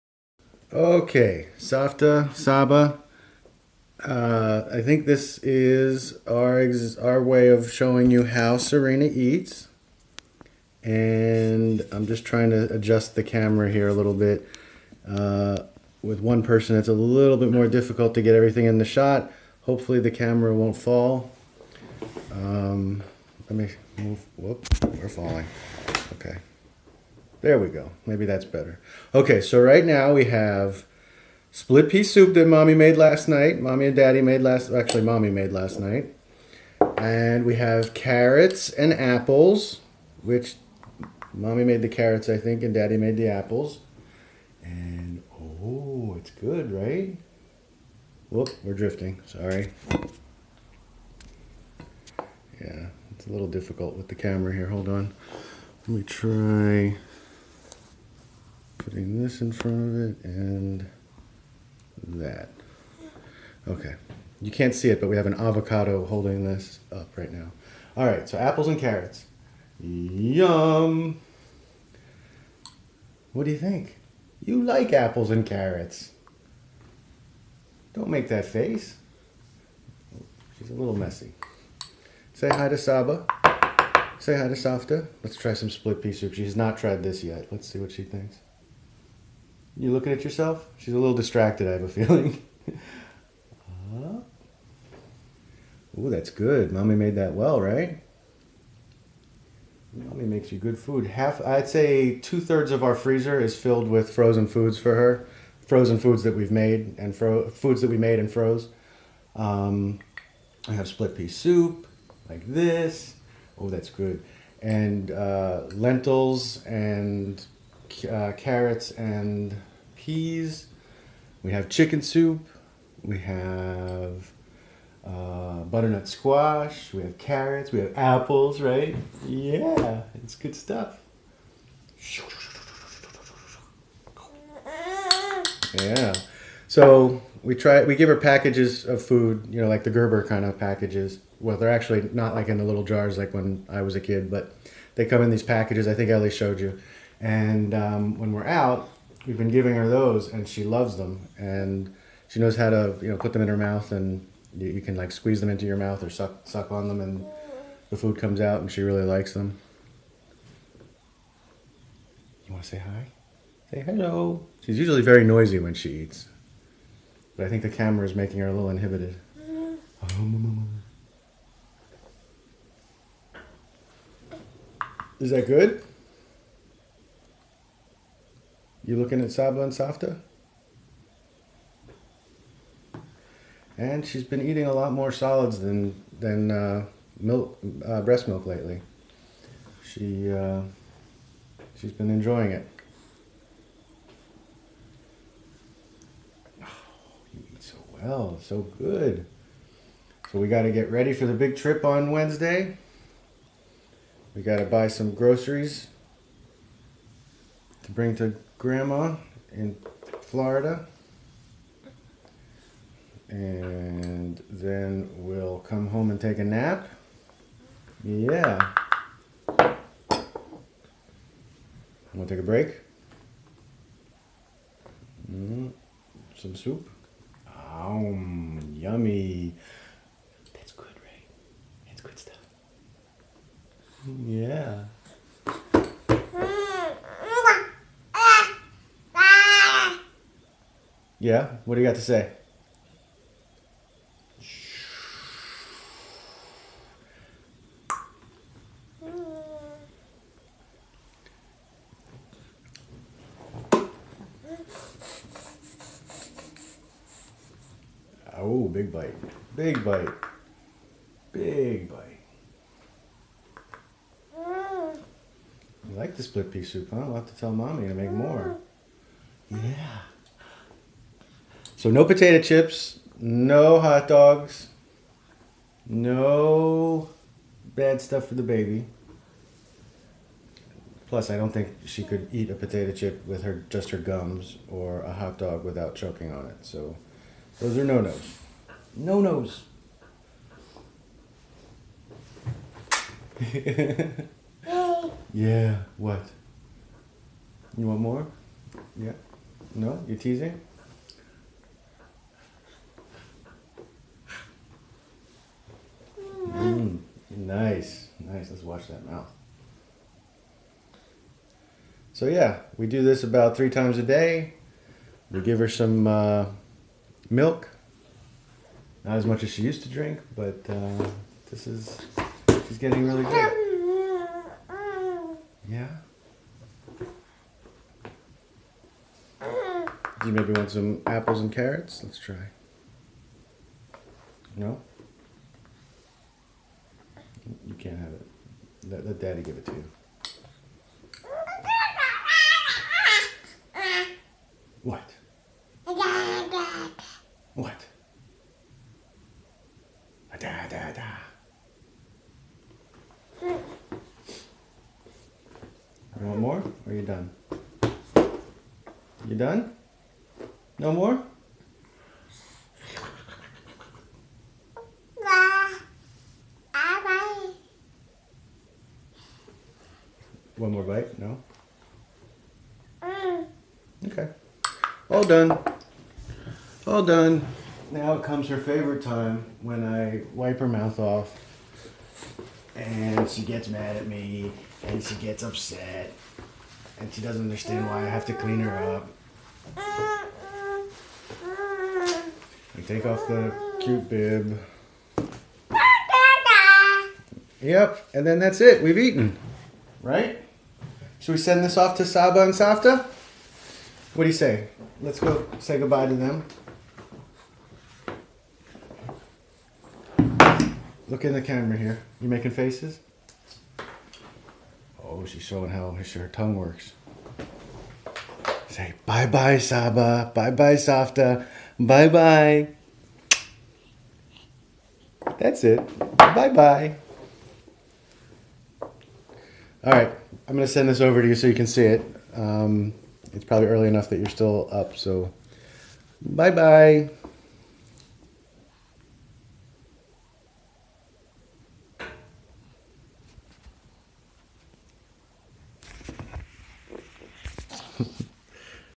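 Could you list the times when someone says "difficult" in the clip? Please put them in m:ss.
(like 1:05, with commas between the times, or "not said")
0:17, 0:53.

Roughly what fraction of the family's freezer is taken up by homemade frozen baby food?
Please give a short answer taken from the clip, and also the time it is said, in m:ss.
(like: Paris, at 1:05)
Two thirds, at 1:42.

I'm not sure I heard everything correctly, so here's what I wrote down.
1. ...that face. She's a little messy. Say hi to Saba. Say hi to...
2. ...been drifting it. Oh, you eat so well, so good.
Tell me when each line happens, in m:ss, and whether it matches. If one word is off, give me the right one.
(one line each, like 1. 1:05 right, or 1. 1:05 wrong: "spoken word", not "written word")
1. 1:18 right
2. 3:11 wrong: "enjoying", not "drifting".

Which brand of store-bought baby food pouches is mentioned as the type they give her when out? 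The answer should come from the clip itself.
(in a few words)
Gerber.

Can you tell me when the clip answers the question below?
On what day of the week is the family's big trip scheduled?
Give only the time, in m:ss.
3:22.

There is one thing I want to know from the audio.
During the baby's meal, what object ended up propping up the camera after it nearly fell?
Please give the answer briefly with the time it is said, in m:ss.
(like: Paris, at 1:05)
An avocado, at 1:05.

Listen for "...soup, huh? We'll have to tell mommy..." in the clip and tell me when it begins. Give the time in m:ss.
4:26.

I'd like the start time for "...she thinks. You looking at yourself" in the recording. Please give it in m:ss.
1:27.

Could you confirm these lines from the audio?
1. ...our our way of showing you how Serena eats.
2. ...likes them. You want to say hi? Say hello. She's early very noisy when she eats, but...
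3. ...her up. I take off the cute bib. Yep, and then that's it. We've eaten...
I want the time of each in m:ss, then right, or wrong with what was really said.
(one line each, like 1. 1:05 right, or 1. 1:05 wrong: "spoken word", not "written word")
1. 0:06 right
2. 2:39 wrong: "usually", not "early"
3. 6:28 right.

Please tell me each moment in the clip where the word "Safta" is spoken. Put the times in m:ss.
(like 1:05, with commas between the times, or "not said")
0:01, 1:24, 2:59, 6:42, 7:00.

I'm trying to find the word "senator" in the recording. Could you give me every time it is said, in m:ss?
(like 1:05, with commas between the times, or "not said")
not said.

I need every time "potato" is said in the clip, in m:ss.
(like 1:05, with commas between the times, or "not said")
4:32, 4:42.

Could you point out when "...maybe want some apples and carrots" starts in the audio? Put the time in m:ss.
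5:30.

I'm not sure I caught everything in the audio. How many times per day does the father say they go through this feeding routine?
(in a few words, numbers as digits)
3.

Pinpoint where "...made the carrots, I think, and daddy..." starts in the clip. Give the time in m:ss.
0:41.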